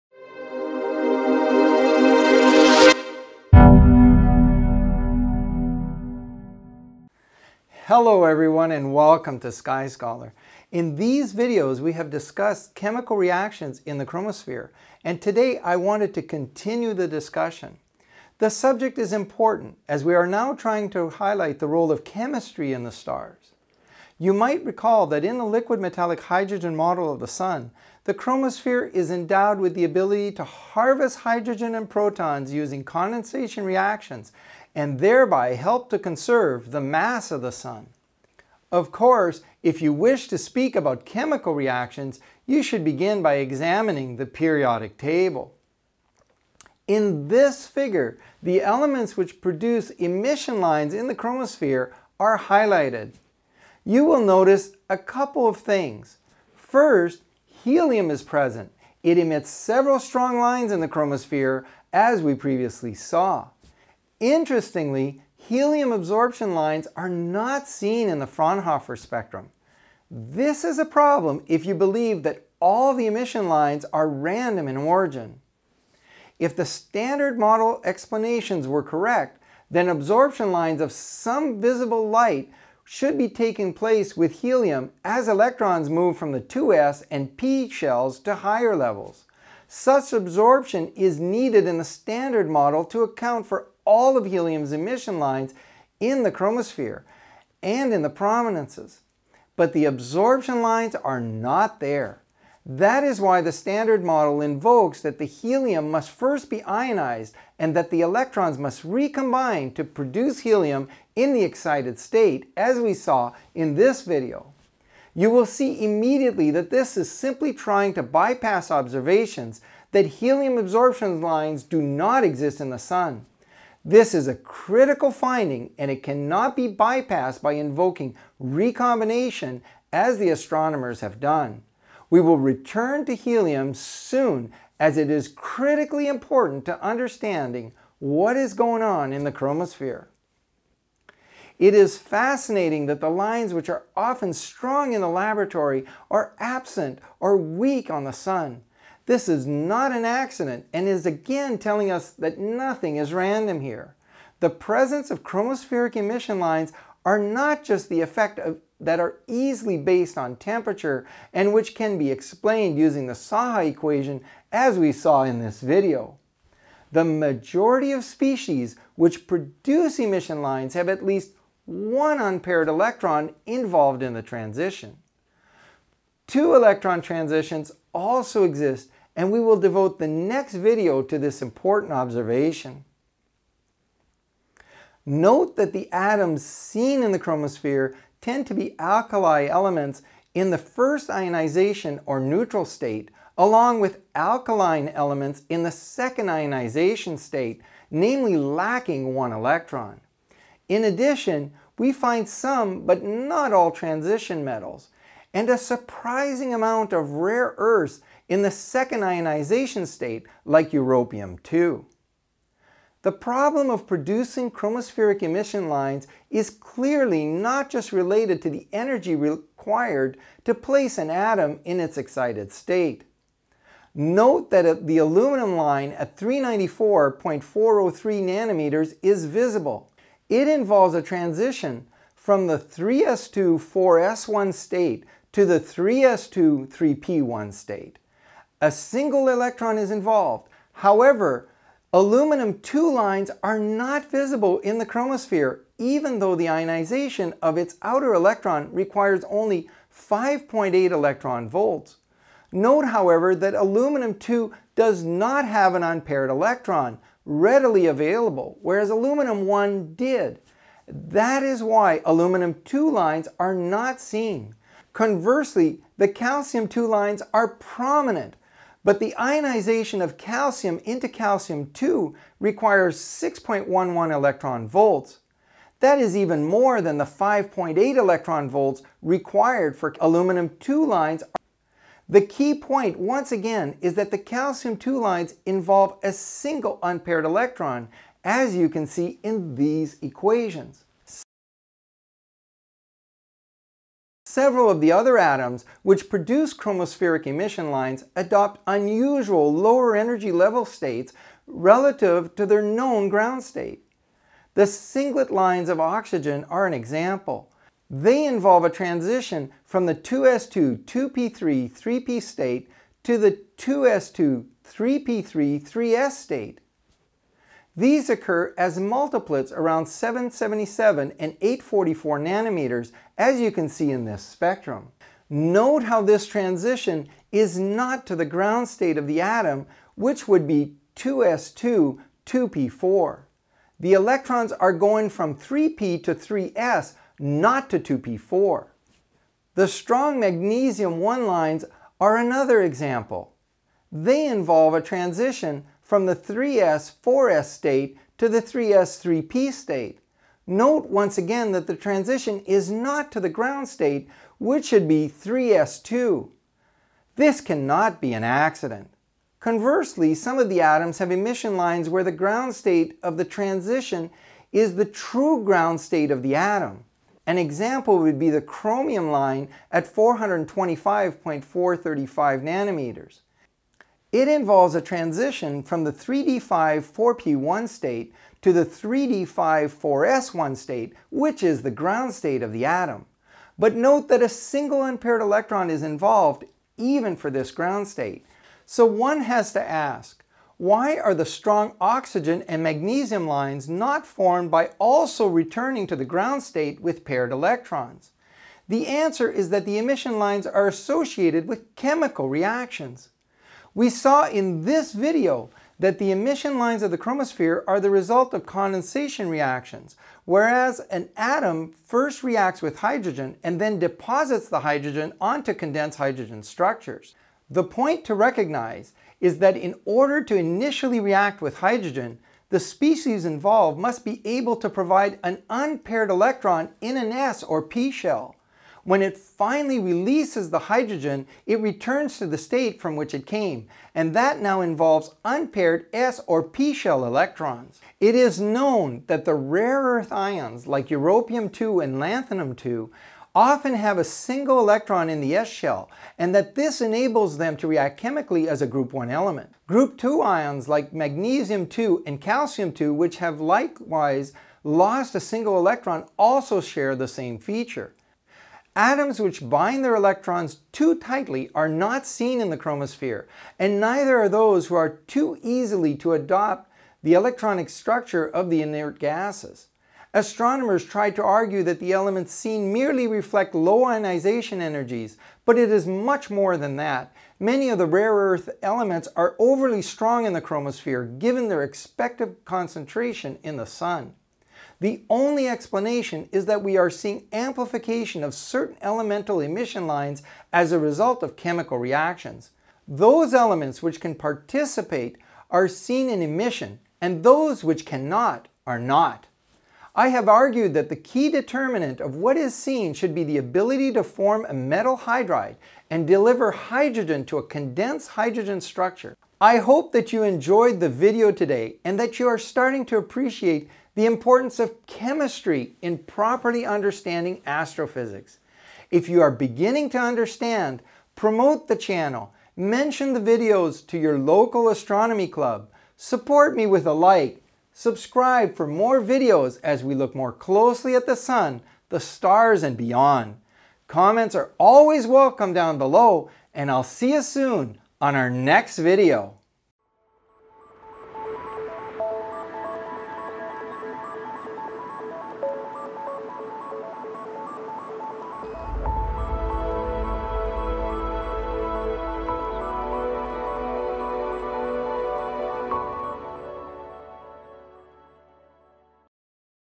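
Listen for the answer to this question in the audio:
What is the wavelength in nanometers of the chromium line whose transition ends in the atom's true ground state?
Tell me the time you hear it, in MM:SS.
06:09.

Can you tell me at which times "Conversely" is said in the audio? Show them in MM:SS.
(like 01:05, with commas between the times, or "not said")
04:24, 05:59.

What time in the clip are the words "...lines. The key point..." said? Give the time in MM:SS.
04:40.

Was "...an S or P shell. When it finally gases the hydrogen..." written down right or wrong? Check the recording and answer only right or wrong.
wrong.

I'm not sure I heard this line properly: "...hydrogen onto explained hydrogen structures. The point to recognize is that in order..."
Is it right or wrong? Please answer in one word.
wrong.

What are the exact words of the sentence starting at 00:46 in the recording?
In this figure, the elements which produce emission lines in the chromosphere are highlighted.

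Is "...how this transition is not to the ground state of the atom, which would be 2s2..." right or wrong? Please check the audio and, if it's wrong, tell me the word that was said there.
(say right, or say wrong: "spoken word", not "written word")
right.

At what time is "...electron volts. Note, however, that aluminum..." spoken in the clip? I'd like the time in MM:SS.
04:10.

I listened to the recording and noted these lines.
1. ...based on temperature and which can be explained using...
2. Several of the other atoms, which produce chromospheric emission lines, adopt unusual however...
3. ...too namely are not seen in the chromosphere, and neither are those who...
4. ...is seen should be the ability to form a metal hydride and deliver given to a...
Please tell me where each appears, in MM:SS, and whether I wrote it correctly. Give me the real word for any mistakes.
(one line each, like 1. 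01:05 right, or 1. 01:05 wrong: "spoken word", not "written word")
1. 02:39 right
2. 04:54 wrong: "lower", not "however"
3. 07:40 wrong: "tightly", not "namely"
4. 08:22 wrong: "hydrogen", not "given".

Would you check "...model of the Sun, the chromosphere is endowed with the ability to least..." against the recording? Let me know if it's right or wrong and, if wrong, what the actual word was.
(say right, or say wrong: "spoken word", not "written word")
wrong: "harvest", not "least".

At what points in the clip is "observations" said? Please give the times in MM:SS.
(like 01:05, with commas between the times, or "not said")
01:58, 03:01.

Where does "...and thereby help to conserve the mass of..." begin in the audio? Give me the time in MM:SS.
00:34.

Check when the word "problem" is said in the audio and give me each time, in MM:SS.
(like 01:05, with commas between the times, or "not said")
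01:10, 03:33.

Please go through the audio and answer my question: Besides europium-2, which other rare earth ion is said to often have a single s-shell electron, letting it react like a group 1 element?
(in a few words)
lanthanum-2.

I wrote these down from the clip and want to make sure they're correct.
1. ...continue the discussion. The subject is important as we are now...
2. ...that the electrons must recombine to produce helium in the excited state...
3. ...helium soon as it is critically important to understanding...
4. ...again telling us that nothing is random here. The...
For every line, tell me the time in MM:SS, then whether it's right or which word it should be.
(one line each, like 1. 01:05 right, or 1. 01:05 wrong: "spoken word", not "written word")
1. 00:16 right
2. 01:47 right
3. 02:13 right
4. 02:31 right.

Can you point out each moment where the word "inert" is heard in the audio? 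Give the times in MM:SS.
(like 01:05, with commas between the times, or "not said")
07:48.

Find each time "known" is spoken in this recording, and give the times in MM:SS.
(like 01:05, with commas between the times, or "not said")
05:02, 07:18.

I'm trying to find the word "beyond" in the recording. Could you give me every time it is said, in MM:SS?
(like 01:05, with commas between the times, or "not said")
08:52.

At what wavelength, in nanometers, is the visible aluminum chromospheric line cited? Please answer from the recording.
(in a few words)
394.403.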